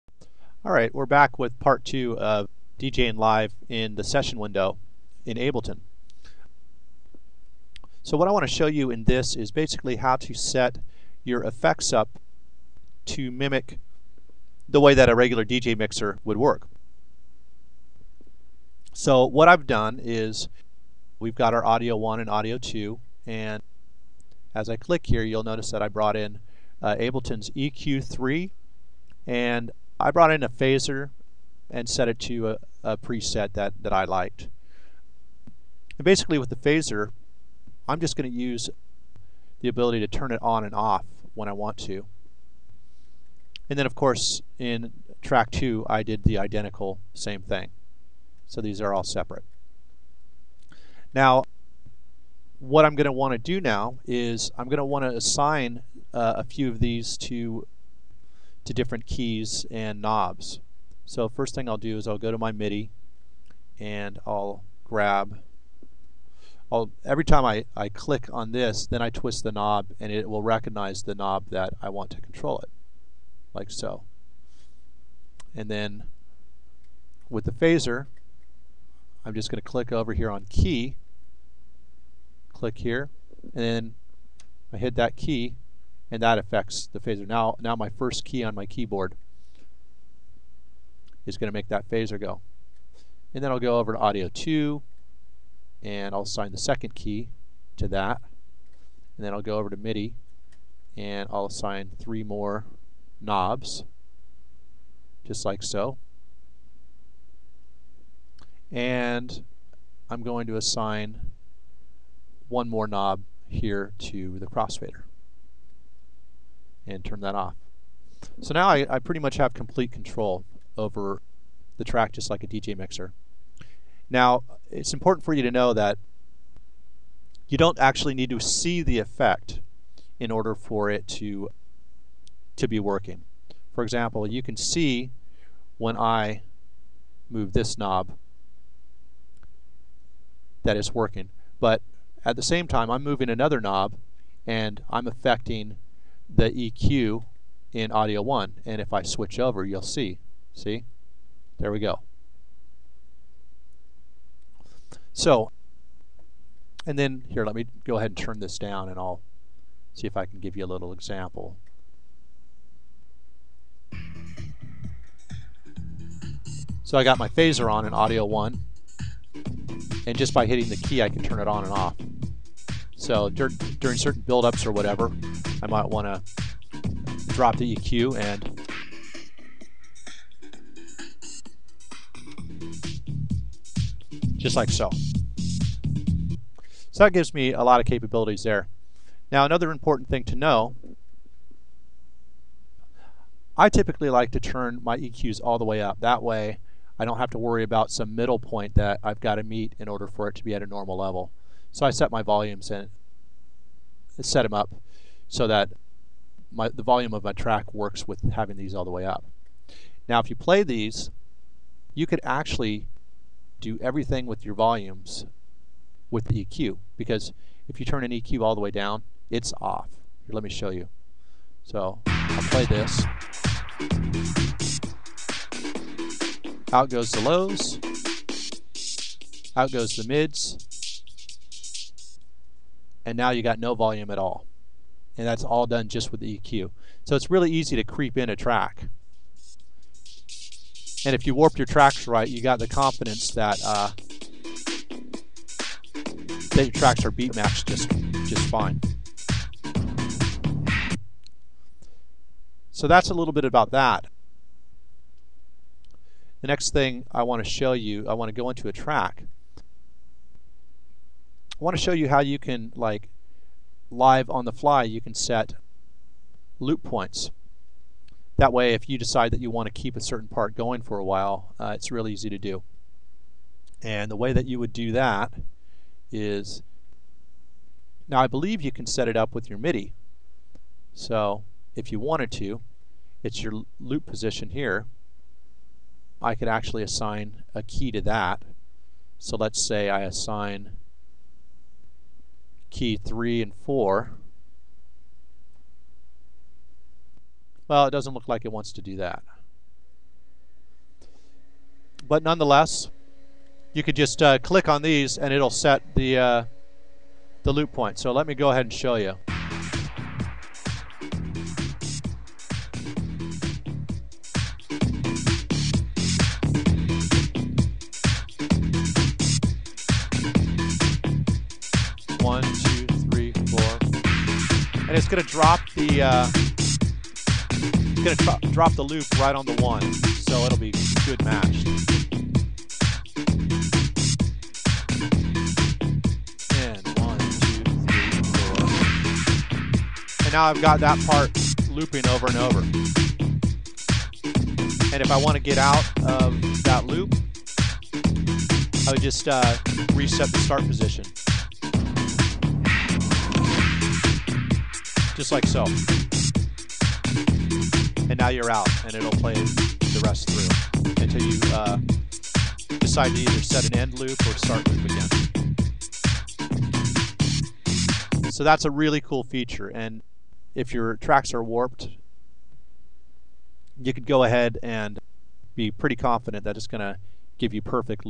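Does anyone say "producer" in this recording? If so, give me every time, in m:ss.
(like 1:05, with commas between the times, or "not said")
not said.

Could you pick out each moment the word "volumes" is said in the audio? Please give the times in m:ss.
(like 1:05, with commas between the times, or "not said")
3:22, 3:26, 3:34, 3:53.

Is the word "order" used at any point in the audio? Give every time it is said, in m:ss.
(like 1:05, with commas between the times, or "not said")
2:10, 3:19.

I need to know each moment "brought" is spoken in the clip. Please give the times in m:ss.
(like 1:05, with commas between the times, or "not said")
0:25, 0:30.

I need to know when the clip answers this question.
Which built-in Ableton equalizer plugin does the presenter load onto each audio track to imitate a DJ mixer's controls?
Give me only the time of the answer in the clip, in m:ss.
0:27.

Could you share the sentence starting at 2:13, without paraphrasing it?
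For example, you can see when I move this knob that it's working.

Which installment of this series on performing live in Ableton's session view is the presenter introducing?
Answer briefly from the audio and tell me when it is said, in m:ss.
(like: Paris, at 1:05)
part two, at 0:01.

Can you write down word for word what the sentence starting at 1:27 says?
Now, now my first key on my keyboard is going to make that phaser go.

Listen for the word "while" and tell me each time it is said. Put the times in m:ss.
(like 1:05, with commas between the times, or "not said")
4:31.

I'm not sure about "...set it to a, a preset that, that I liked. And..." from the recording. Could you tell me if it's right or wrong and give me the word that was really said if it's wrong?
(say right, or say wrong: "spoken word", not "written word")
right.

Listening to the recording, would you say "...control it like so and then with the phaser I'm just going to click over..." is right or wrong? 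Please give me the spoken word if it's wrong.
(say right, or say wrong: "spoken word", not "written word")
right.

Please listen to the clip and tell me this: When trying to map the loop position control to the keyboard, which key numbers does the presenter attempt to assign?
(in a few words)
3 and 4.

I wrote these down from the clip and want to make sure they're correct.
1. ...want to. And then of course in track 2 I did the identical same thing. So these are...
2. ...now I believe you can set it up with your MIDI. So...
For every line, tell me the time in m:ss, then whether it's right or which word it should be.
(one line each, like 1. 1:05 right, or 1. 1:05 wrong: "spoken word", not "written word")
1. 0:41 right
2. 4:38 right.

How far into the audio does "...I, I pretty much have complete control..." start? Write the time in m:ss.
1:58.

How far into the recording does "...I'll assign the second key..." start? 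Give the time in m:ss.
1:36.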